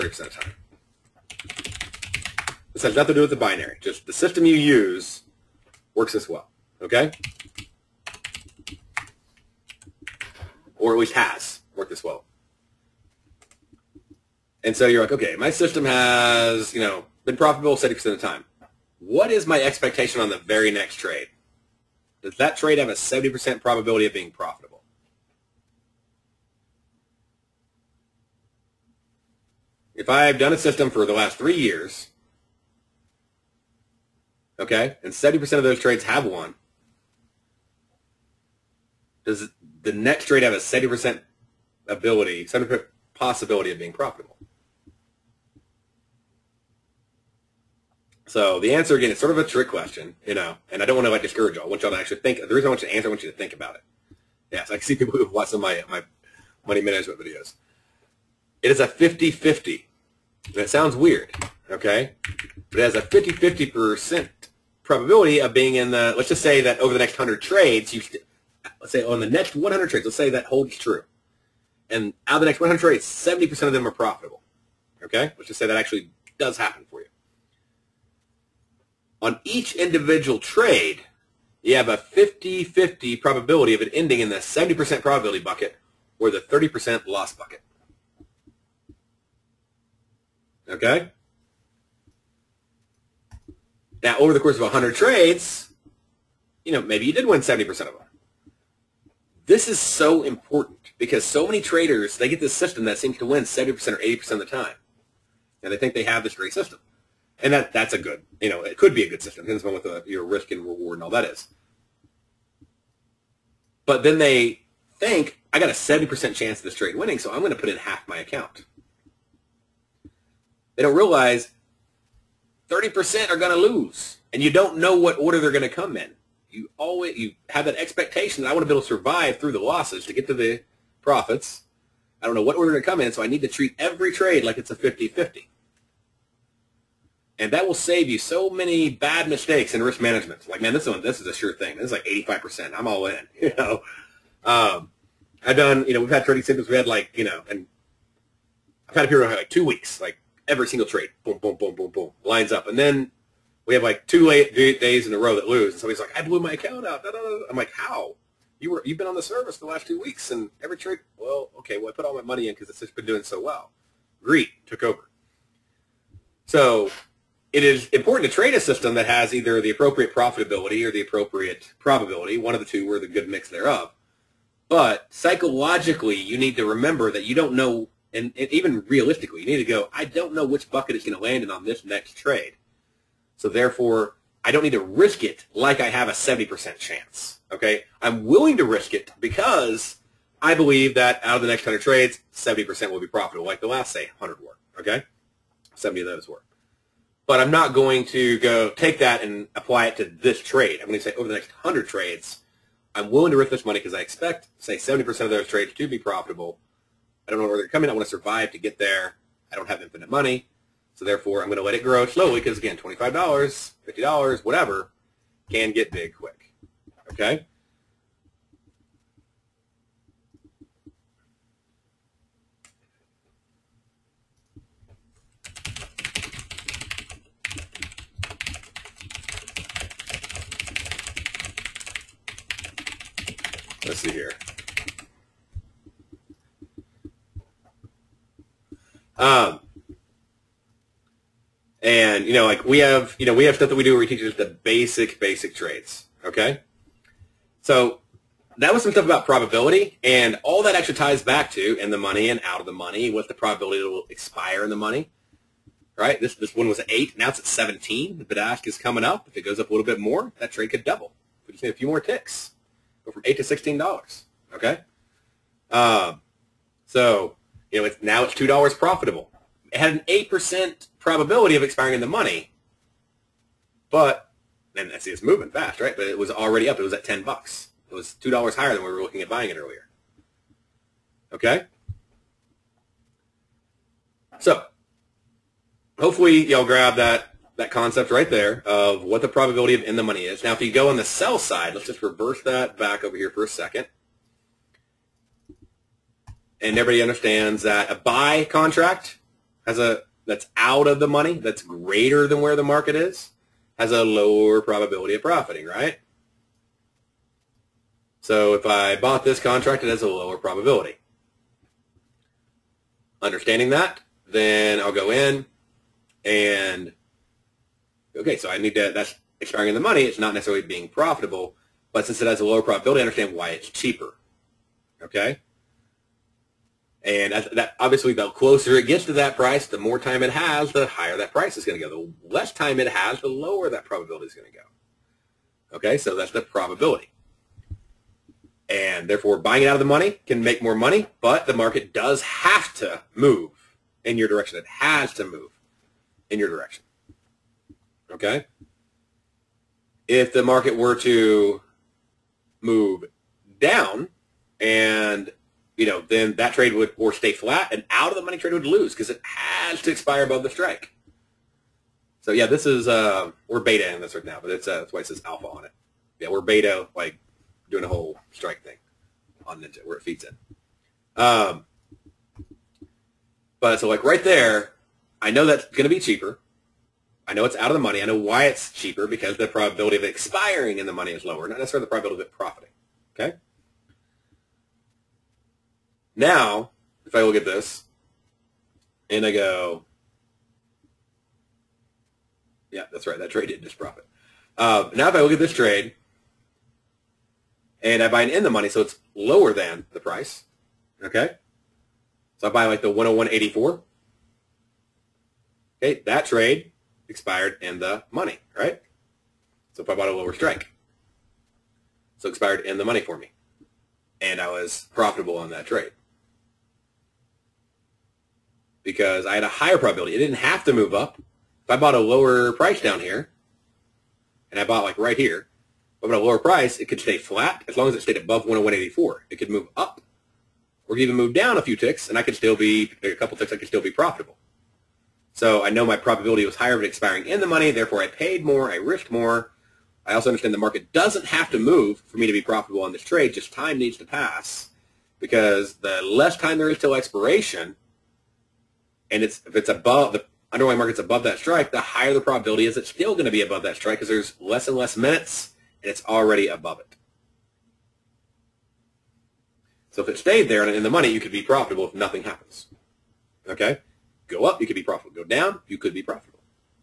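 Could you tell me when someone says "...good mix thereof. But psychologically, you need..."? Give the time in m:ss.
2:53.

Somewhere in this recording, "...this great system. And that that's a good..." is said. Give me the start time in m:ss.
1:46.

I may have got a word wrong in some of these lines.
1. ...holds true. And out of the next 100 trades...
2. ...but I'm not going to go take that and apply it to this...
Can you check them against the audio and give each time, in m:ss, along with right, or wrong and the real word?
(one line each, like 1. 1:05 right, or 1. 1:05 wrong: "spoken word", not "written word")
1. 1:10 right
2. 3:17 right.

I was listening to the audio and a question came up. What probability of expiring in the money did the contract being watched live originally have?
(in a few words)
8%.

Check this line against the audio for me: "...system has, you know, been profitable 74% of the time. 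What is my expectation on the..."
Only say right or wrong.
wrong.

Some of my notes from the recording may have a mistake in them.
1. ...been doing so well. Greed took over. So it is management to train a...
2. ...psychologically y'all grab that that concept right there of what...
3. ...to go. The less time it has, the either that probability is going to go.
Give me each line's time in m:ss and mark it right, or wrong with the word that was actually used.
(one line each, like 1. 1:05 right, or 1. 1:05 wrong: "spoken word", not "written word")
1. 2:42 wrong: "important", not "management"
2. 4:45 wrong: "hopefully", not "psychologically"
3. 5:31 wrong: "lower", not "either".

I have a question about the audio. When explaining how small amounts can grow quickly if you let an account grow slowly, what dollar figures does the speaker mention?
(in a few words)
$25, $50.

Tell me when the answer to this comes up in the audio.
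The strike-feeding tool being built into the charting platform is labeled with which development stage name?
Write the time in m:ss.
6:05.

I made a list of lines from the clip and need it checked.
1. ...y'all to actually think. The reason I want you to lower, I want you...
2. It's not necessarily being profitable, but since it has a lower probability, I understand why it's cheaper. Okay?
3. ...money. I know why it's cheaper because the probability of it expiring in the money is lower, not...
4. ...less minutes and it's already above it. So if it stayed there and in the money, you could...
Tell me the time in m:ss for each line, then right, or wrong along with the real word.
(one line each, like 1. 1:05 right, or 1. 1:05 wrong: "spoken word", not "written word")
1. 0:51 wrong: "answer", not "lower"
2. 5:20 right
3. 6:17 right
4. 7:34 right.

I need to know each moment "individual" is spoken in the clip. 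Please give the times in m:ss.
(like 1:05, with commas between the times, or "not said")
1:19.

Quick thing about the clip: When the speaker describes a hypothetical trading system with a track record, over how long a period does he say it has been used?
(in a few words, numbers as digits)
3 years.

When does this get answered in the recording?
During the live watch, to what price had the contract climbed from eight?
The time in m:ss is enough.
4:17.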